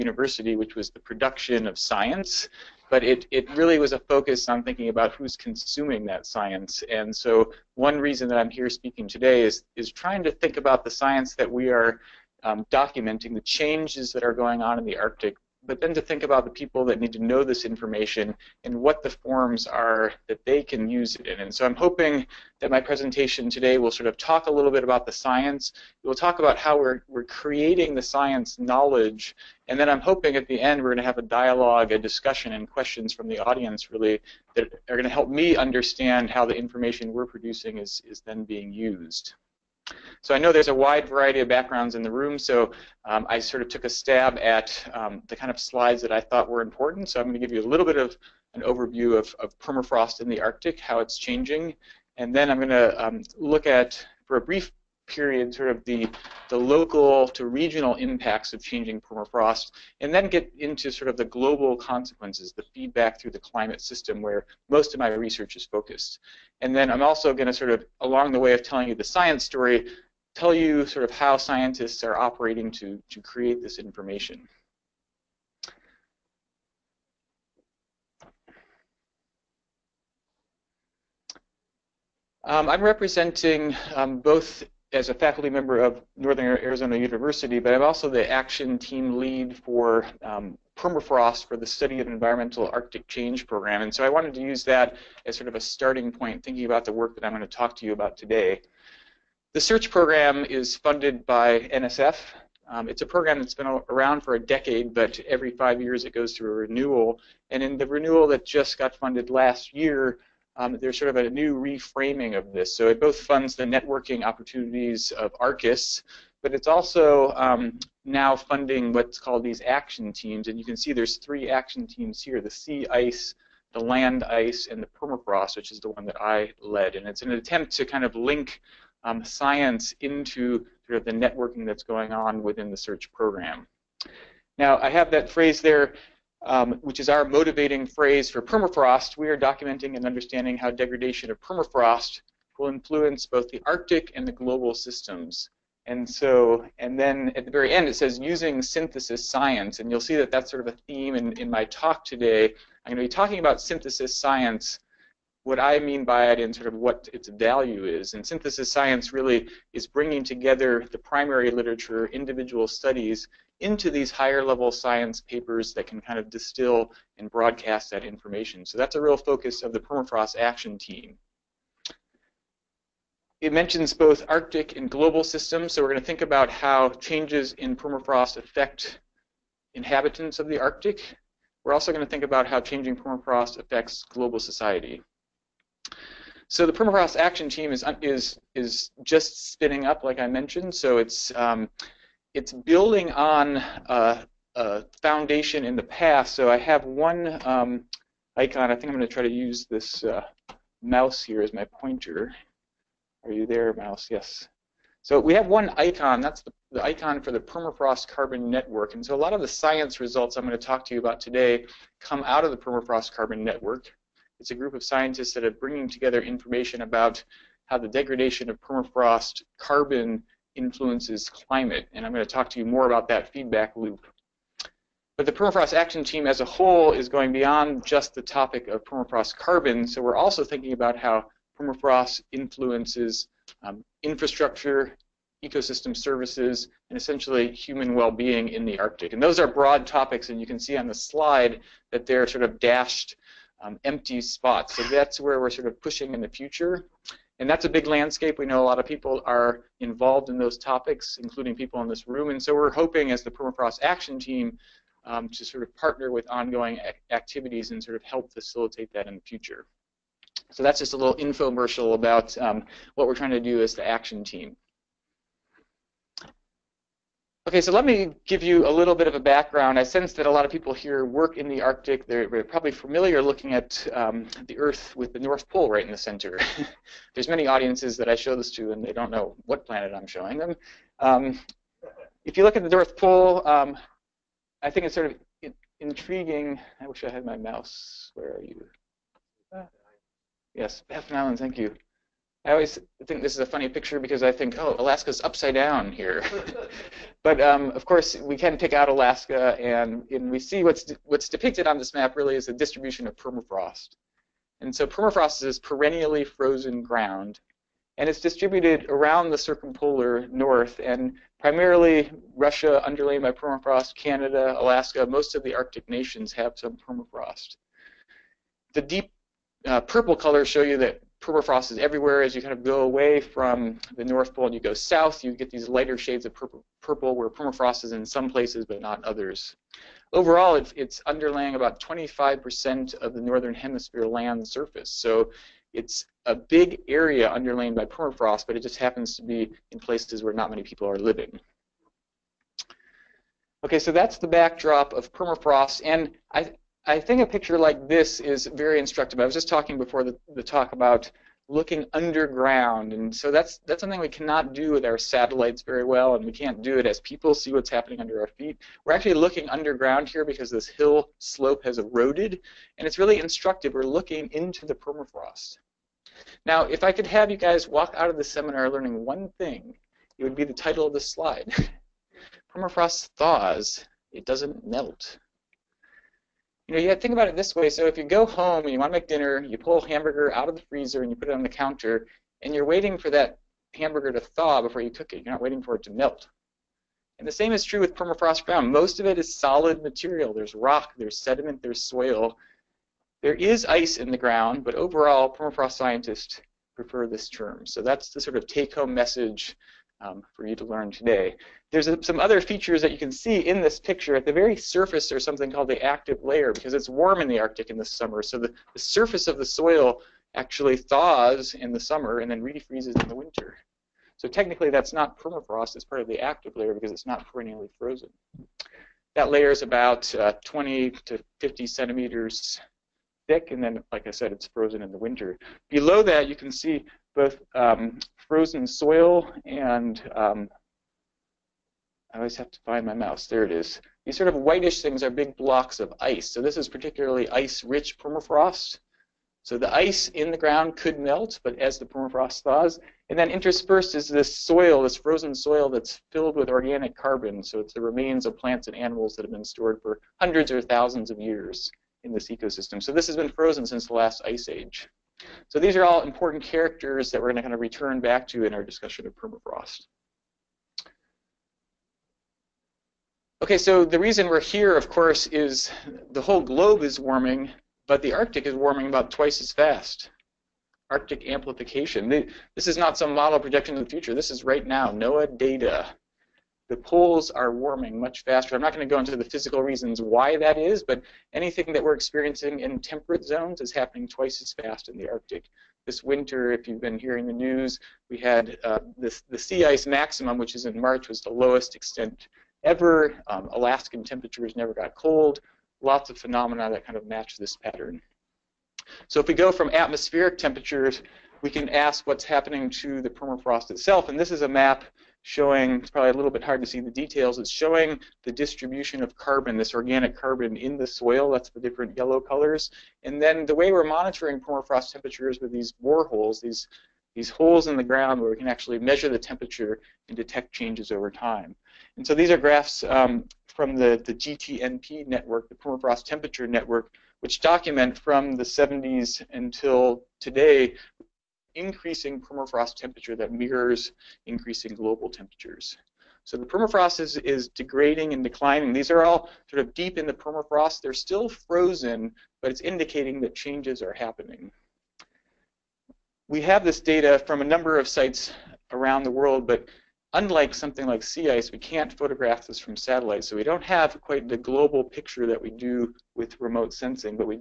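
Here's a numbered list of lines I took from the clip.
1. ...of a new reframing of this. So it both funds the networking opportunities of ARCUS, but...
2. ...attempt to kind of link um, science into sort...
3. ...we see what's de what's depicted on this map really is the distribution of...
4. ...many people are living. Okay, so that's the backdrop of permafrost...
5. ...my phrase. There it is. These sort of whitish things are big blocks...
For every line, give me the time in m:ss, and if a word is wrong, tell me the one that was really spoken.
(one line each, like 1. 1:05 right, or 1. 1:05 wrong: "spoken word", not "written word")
1. 1:51 right
2. 2:07 right
3. 5:00 right
4. 5:40 right
5. 7:12 wrong: "mouse", not "phrase".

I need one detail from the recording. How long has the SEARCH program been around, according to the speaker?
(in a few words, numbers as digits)
a decade.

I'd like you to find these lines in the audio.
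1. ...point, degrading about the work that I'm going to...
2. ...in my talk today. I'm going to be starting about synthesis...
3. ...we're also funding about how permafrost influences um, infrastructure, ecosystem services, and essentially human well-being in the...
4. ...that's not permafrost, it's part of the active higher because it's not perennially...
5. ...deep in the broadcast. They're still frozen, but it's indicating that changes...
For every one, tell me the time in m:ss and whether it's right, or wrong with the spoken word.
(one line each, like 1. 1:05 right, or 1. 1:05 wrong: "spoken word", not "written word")
1. 1:36 wrong: "thinking", not "degrading"
2. 2:31 wrong: "talking", not "starting"
3. 3:50 wrong: "thinking", not "funding"
4. 6:54 wrong: "layer", not "higher"
5. 8:59 wrong: "permafrost", not "broadcast".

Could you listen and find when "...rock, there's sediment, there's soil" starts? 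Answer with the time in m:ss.
6:30.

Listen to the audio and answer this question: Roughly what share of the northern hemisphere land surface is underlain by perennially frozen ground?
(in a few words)
25%.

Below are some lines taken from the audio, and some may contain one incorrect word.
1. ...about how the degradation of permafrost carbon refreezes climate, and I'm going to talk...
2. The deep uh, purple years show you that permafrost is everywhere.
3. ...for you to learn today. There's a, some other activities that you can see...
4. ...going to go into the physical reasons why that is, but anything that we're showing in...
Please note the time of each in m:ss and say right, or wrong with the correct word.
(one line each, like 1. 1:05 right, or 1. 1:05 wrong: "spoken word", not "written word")
1. 3:36 wrong: "influences", not "refreezes"
2. 5:18 wrong: "colors", not "years"
3. 6:40 wrong: "features", not "activities"
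4. 7:58 wrong: "experiencing", not "showing".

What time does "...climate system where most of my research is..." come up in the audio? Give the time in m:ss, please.
1:03.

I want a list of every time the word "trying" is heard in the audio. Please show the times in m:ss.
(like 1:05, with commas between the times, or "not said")
0:09, 4:23.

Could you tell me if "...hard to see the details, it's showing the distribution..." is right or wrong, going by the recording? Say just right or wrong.
right.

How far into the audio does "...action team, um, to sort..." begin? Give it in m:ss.
4:13.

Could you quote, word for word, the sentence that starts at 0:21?
And so I'm hoping that my presentation today will sort of talk a little bit about the science.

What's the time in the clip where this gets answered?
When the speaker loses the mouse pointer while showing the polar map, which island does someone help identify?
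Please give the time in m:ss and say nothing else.
4:50.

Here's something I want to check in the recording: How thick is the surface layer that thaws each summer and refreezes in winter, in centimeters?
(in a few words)
20 to 50 centimeters.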